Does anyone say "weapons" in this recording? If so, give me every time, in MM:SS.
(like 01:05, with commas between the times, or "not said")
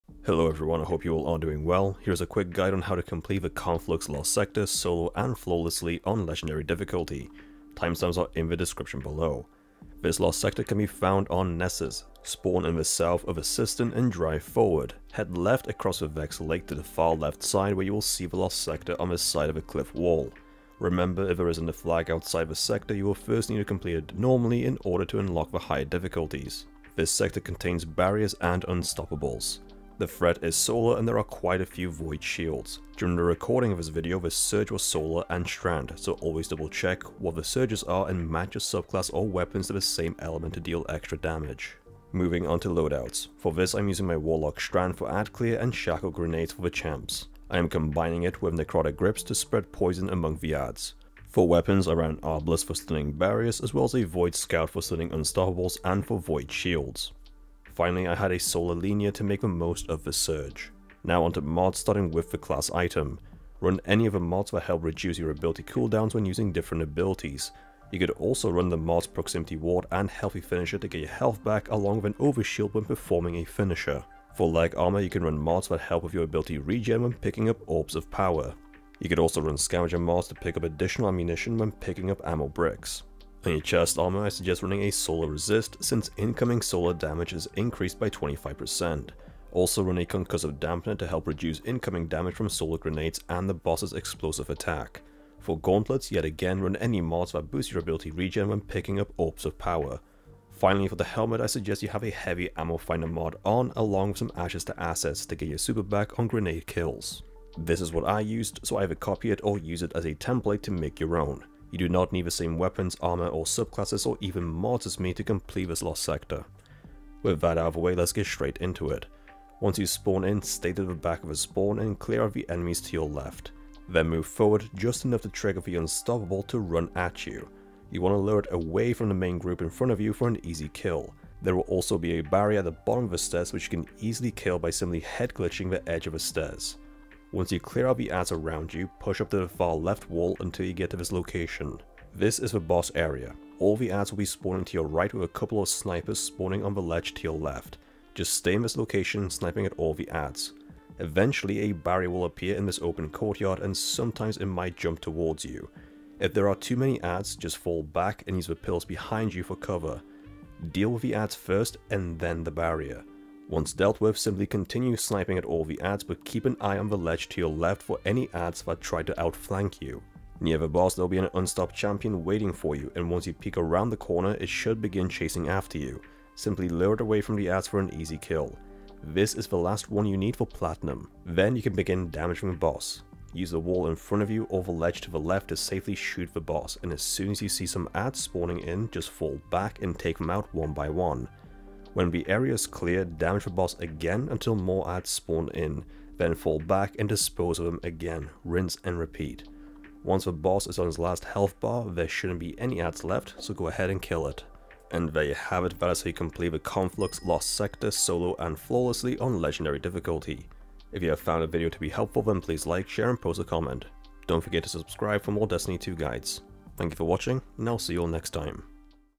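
00:39, 00:51, 01:52.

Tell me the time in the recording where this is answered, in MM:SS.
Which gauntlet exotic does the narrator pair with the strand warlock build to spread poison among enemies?
00:48.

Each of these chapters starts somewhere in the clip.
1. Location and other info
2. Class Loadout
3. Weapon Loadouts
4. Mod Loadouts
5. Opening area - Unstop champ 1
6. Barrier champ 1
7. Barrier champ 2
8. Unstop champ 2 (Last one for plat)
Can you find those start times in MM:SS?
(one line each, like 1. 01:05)
1. 00:10
2. 00:41
3. 00:51
4. 01:01
5. 01:58
6. 02:11
7. 02:22
8. 02:50.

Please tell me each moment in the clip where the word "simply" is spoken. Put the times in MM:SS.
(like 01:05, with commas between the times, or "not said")
02:14, 02:44, 02:56.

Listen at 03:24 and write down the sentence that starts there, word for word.
And there you have it, that is how you complete the Conflux Lost Sector solo and flawlessly on Legendary difficulty.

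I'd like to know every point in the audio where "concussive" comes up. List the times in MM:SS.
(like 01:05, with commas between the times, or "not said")
01:30.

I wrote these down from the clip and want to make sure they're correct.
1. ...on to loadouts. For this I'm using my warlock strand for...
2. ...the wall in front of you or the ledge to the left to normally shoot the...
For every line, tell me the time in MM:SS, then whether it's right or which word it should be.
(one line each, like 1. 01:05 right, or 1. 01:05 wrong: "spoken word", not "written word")
1. 00:42 right
2. 03:03 wrong: "safely", not "normally".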